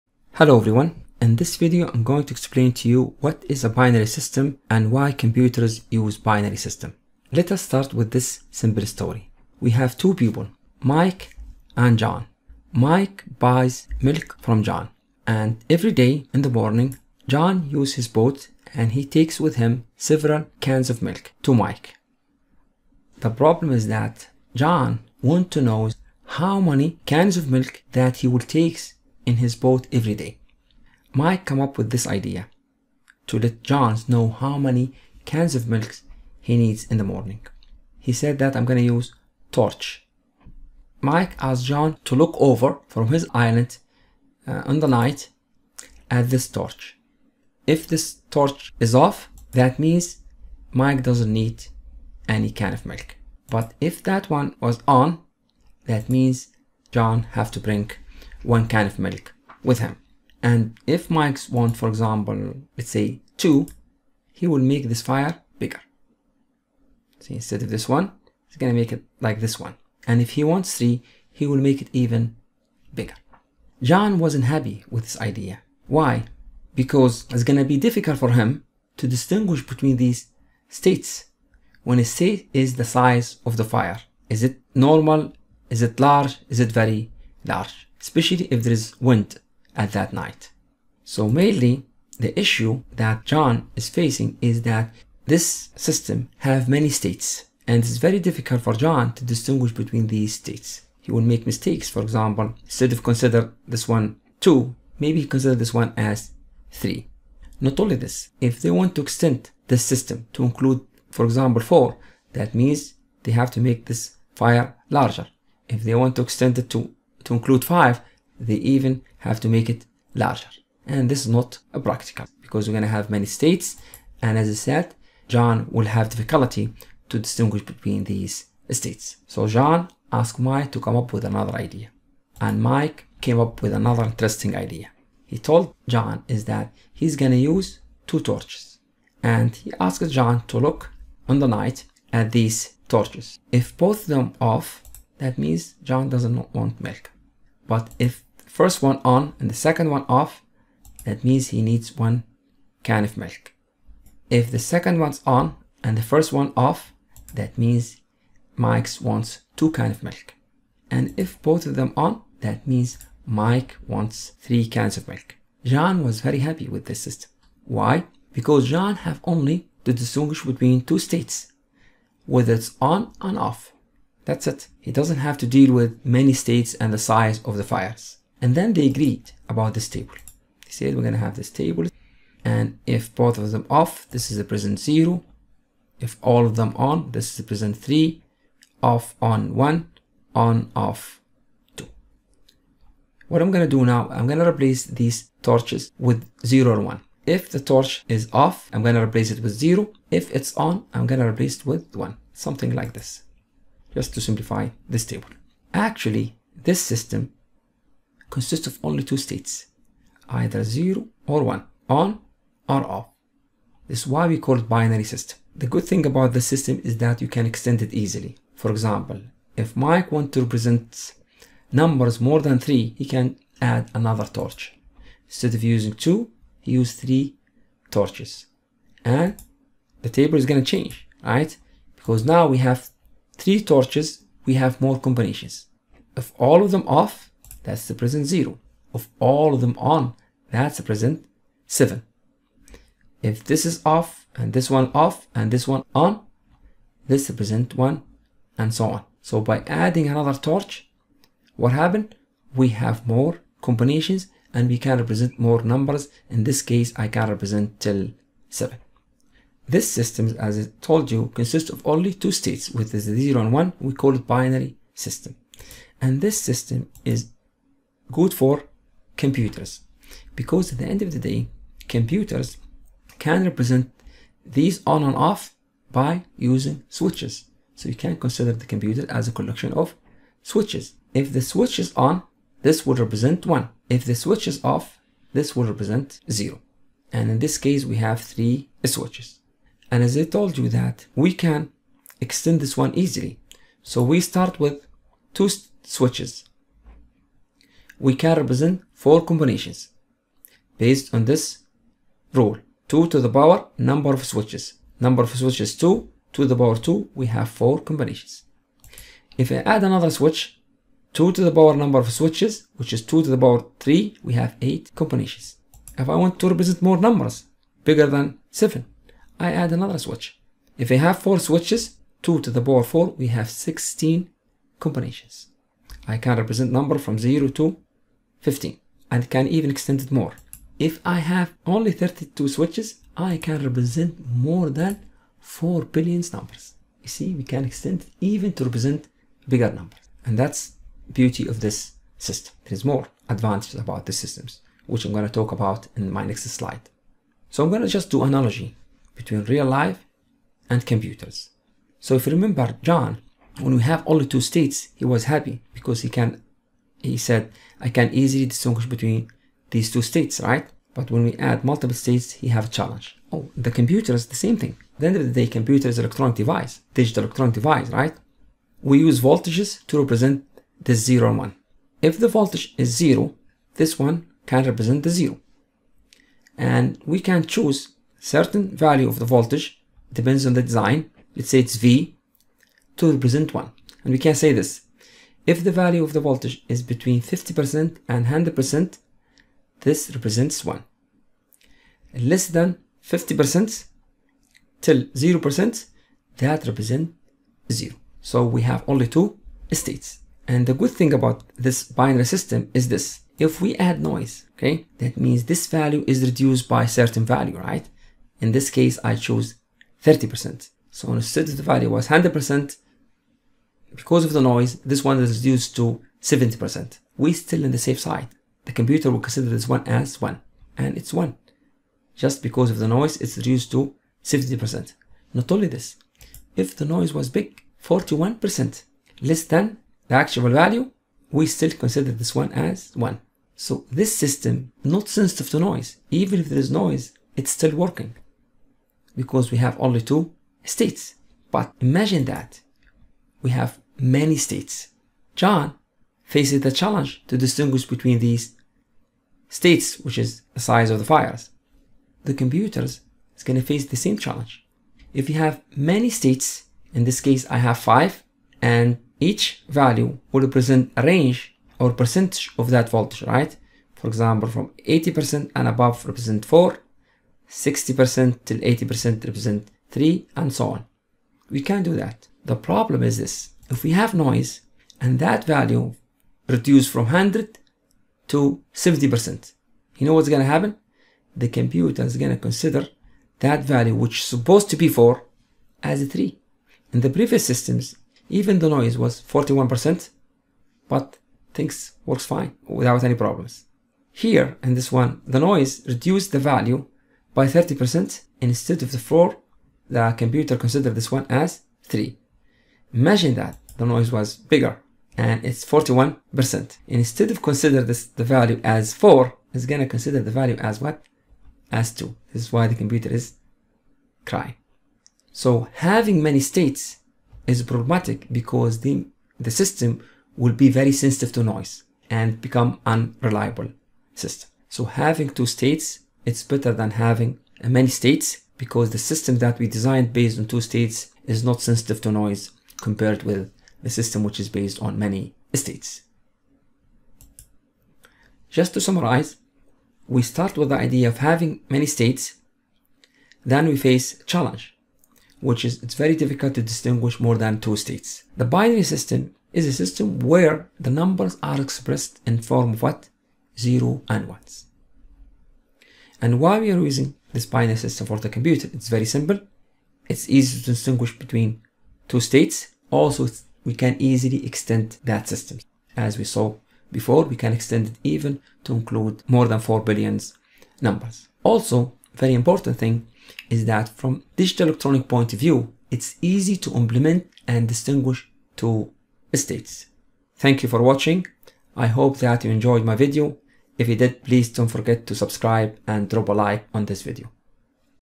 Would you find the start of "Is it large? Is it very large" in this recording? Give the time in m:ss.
1:25.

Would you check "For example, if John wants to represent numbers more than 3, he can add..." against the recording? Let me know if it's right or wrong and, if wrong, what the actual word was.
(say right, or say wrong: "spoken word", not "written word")
wrong: "Mike", not "John".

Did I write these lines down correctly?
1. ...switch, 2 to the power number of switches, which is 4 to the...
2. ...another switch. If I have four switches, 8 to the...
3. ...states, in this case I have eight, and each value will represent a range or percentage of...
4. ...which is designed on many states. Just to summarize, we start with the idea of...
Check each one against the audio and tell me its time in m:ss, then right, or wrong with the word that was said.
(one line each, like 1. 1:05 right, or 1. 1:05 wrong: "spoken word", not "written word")
1. 5:10 wrong: "2", not "4"
2. 5:19 wrong: "2", not "8"
3. 7:36 wrong: "five", not "eight"
4. 8:54 wrong: "based", not "designed".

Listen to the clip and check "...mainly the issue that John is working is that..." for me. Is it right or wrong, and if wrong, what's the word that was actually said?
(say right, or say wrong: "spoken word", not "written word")
wrong: "facing", not "working".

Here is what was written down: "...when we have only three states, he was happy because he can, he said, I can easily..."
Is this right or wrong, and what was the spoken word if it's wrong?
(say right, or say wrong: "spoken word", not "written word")
wrong: "two", not "three".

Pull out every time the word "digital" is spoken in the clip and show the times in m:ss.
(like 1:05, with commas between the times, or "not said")
6:06, 9:34.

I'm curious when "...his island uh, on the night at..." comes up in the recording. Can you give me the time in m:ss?
0:43.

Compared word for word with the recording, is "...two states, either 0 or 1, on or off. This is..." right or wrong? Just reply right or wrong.
right.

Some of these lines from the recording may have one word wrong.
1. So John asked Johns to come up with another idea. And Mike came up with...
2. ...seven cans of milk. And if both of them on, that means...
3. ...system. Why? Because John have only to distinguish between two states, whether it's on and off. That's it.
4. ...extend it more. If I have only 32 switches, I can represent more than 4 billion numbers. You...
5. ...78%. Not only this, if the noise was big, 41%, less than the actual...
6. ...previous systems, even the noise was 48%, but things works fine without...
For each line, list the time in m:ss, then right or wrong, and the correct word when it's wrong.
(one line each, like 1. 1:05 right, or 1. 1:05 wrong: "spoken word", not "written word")
1. 2:09 wrong: "Mike", not "Johns"
2. 2:39 wrong: "two", not "seven"
3. 2:46 right
4. 5:29 right
5. 7:04 wrong: "70", not "78"
6. 8:07 wrong: "41", not "48".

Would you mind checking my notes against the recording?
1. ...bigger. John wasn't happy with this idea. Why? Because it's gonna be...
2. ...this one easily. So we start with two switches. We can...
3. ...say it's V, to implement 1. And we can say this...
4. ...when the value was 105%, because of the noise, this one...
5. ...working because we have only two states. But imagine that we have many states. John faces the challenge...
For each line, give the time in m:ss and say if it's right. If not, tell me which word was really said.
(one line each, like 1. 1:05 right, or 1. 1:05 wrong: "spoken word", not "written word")
1. 1:12 right
2. 4:52 right
3. 6:21 wrong: "represent", not "implement"
4. 6:51 wrong: "100", not "105"
5. 7:17 right.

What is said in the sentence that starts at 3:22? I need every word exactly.
Something like this just to simplify this table.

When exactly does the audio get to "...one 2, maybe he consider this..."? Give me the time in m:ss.
1:43.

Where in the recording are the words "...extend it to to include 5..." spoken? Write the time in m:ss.
1:56.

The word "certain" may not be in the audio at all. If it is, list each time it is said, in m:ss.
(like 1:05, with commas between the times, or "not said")
6:18, 6:46.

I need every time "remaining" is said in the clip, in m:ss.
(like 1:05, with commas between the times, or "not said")
not said.